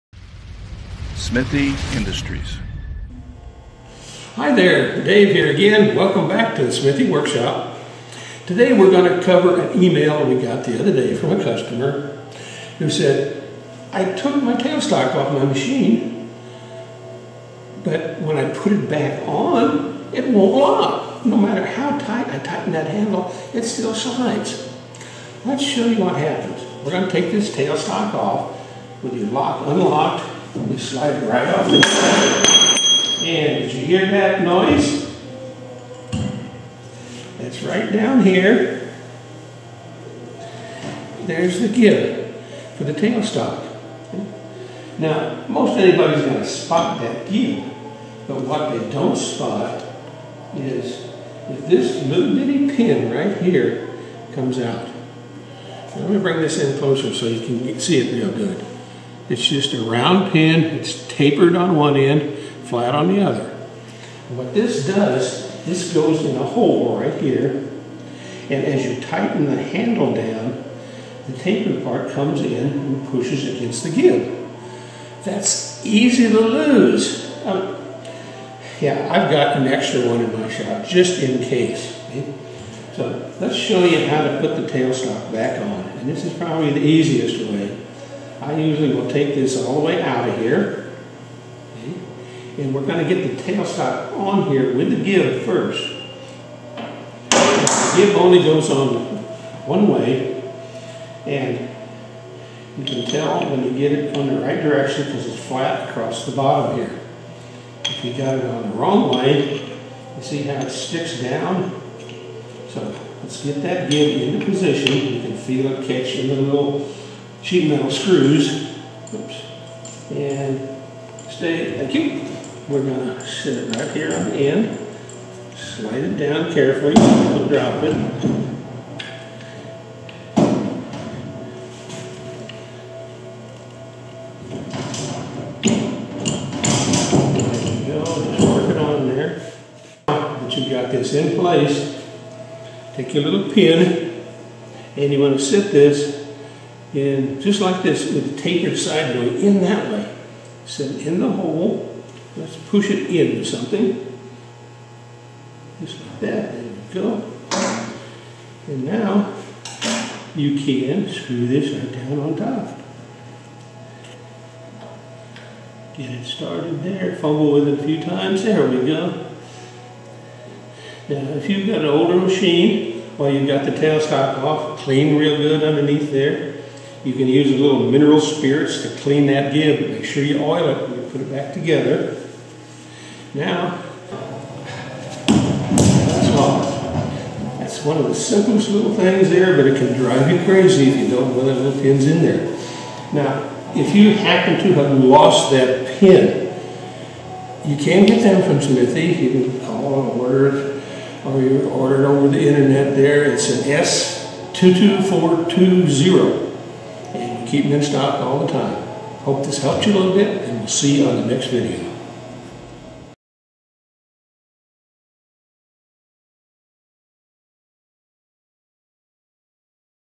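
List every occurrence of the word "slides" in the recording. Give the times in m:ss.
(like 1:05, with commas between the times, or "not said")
0:23, 0:30, 2:05.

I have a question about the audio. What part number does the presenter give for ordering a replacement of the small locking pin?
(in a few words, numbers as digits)
S22420.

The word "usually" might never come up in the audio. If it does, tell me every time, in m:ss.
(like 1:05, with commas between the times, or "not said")
1:28.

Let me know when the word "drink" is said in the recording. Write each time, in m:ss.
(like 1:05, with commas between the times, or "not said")
not said.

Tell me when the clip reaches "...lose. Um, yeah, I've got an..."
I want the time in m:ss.
1:16.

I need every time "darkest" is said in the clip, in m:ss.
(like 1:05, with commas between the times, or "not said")
not said.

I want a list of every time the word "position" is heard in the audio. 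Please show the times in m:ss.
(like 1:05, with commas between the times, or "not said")
1:54.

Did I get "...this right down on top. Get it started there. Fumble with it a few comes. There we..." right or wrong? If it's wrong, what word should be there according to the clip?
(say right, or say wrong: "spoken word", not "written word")
wrong: "times", not "comes".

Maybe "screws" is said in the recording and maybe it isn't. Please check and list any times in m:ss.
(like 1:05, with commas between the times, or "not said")
1:57, 2:41.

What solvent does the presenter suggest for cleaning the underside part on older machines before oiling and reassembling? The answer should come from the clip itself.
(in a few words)
mineral spirits.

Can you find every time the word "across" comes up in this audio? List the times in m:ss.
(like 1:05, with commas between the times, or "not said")
1:45.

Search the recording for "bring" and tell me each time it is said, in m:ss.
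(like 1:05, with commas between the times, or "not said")
0:56.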